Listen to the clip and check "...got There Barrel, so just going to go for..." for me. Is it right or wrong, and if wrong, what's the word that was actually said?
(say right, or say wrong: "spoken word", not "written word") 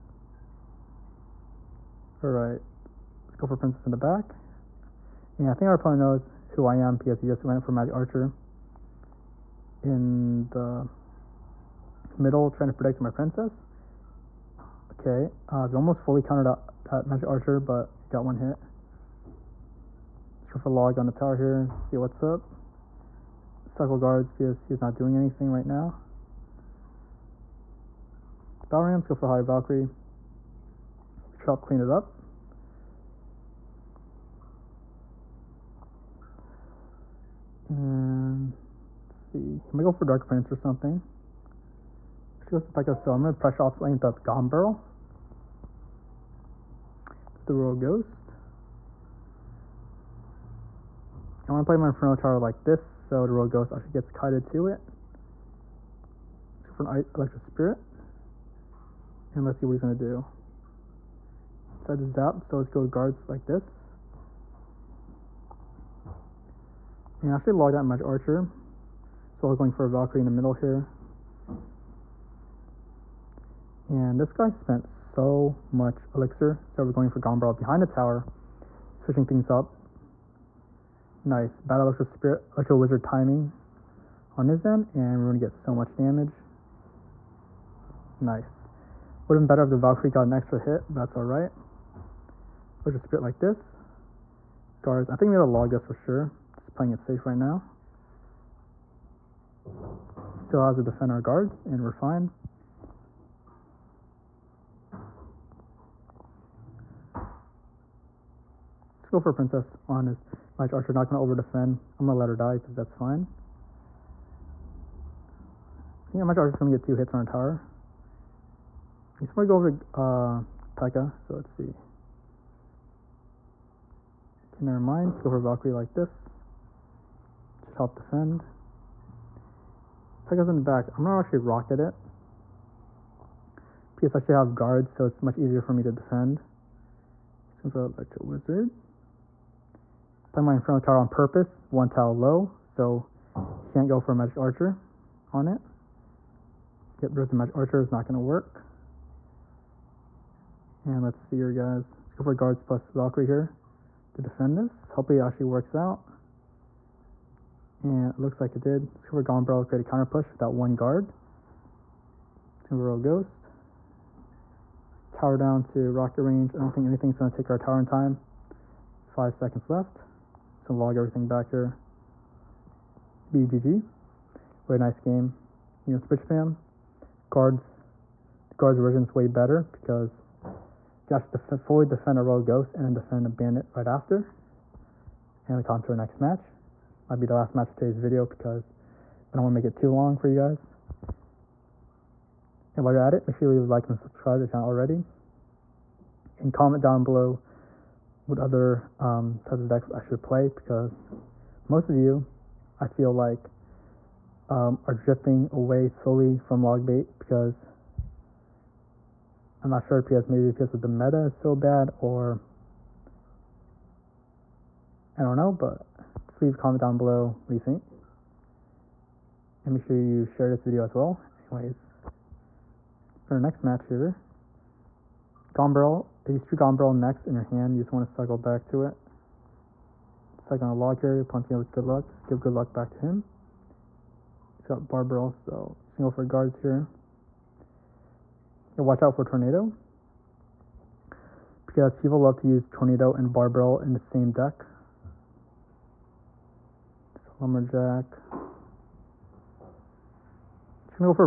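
wrong: "Barb", not "There".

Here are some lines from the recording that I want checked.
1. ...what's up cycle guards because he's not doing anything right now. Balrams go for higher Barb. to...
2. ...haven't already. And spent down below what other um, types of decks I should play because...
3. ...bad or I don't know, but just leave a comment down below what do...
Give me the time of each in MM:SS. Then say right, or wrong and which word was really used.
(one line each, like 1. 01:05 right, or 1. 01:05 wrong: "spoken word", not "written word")
1. 00:21 wrong: "Valkyrie", not "Barb"
2. 03:14 wrong: "comment", not "spent"
3. 03:31 right.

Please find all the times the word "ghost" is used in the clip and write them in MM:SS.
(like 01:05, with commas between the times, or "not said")
00:47, 00:53, 02:42, 03:02.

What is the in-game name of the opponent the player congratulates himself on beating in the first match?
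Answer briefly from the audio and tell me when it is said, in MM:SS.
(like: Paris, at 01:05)
Richpam, at 02:56.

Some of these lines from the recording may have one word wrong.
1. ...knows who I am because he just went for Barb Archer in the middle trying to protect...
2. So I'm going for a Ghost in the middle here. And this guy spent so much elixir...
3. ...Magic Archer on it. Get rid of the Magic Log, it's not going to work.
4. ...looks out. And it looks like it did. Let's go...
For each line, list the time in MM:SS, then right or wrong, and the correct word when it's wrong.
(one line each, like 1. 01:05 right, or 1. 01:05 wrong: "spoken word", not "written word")
1. 00:06 wrong: "Magic", not "Barb"
2. 01:09 wrong: "Valkyrie", not "Ghost"
3. 02:24 wrong: "Archer", not "Log"
4. 02:35 wrong: "works", not "looks".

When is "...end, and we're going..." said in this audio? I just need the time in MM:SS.
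01:24.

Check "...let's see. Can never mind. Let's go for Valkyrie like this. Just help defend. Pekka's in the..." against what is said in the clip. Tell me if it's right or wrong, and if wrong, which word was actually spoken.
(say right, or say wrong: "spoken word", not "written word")
right.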